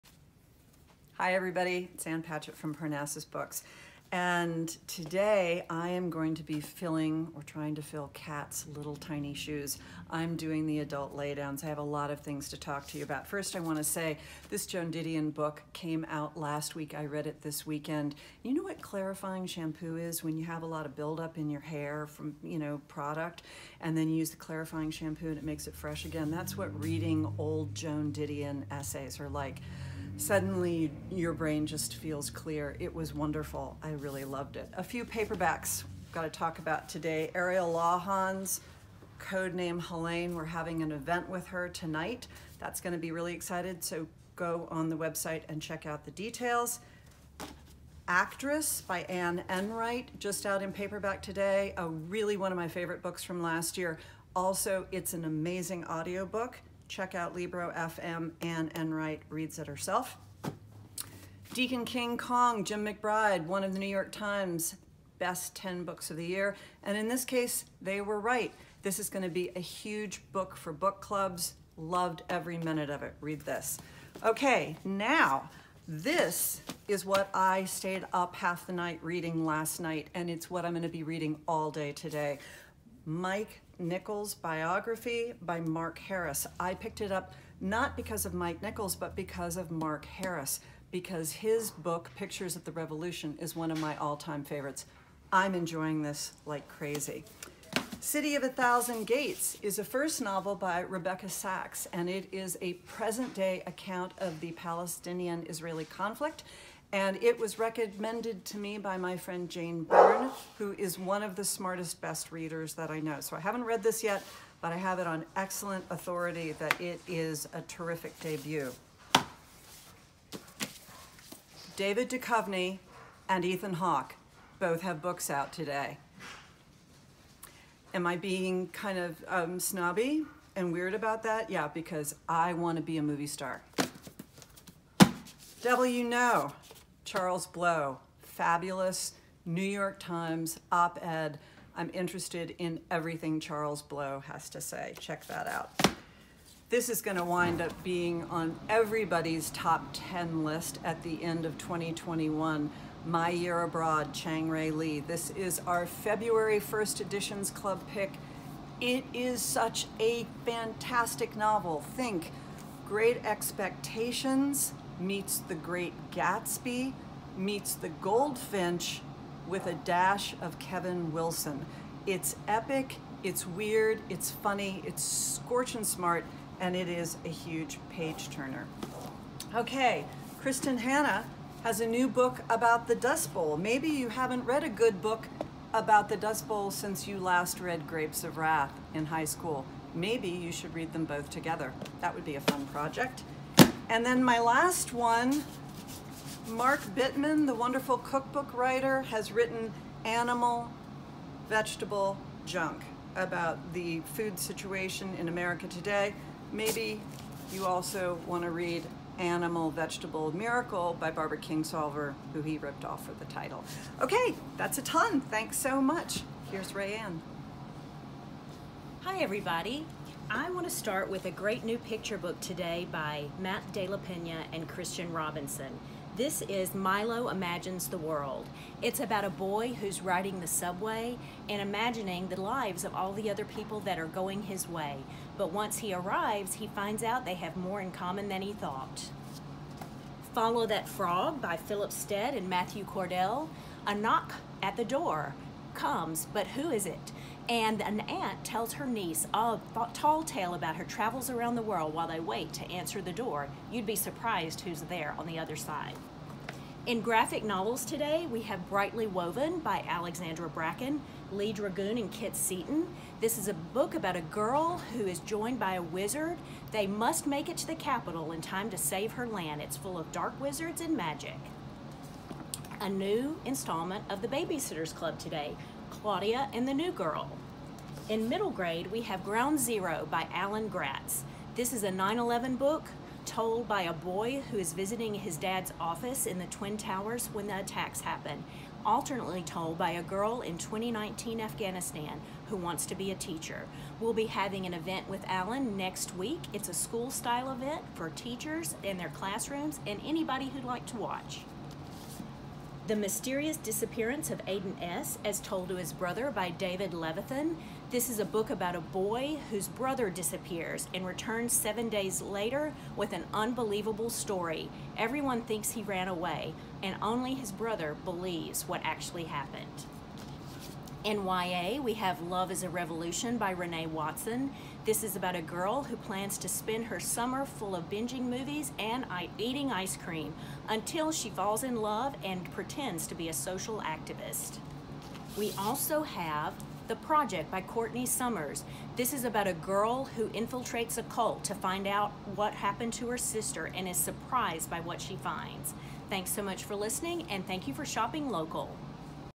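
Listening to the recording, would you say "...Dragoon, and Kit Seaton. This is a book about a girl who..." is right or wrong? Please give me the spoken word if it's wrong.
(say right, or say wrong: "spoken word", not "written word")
right.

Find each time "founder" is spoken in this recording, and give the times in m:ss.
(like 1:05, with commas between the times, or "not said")
not said.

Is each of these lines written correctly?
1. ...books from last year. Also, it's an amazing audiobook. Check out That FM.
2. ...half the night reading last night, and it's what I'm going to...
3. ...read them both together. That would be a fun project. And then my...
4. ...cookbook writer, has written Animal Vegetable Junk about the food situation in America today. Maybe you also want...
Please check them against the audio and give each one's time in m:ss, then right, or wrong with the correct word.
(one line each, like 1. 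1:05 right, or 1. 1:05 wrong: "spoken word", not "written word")
1. 0:53 wrong: "Libro", not "That"
2. 1:18 right
3. 3:10 right
4. 3:17 right.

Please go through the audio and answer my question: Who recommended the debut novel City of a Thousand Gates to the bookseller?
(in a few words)
Jane Byrne.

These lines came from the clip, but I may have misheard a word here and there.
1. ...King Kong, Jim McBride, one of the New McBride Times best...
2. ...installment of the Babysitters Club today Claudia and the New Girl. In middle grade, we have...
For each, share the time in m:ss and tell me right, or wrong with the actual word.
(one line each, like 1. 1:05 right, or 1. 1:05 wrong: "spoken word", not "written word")
1. 1:01 wrong: "York", not "McBride"
2. 4:33 right.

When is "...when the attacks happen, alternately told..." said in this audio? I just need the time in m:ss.
4:47.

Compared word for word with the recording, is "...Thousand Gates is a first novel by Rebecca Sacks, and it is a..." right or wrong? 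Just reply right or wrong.
right.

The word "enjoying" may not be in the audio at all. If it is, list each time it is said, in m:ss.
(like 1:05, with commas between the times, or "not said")
1:35.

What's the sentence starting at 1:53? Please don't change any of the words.
So I haven't read this yet, but I have it on excellent authority that it is a terrific debut.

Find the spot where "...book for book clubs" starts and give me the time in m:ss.
1:10.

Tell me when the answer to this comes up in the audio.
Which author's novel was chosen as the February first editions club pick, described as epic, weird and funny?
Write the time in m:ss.
2:34.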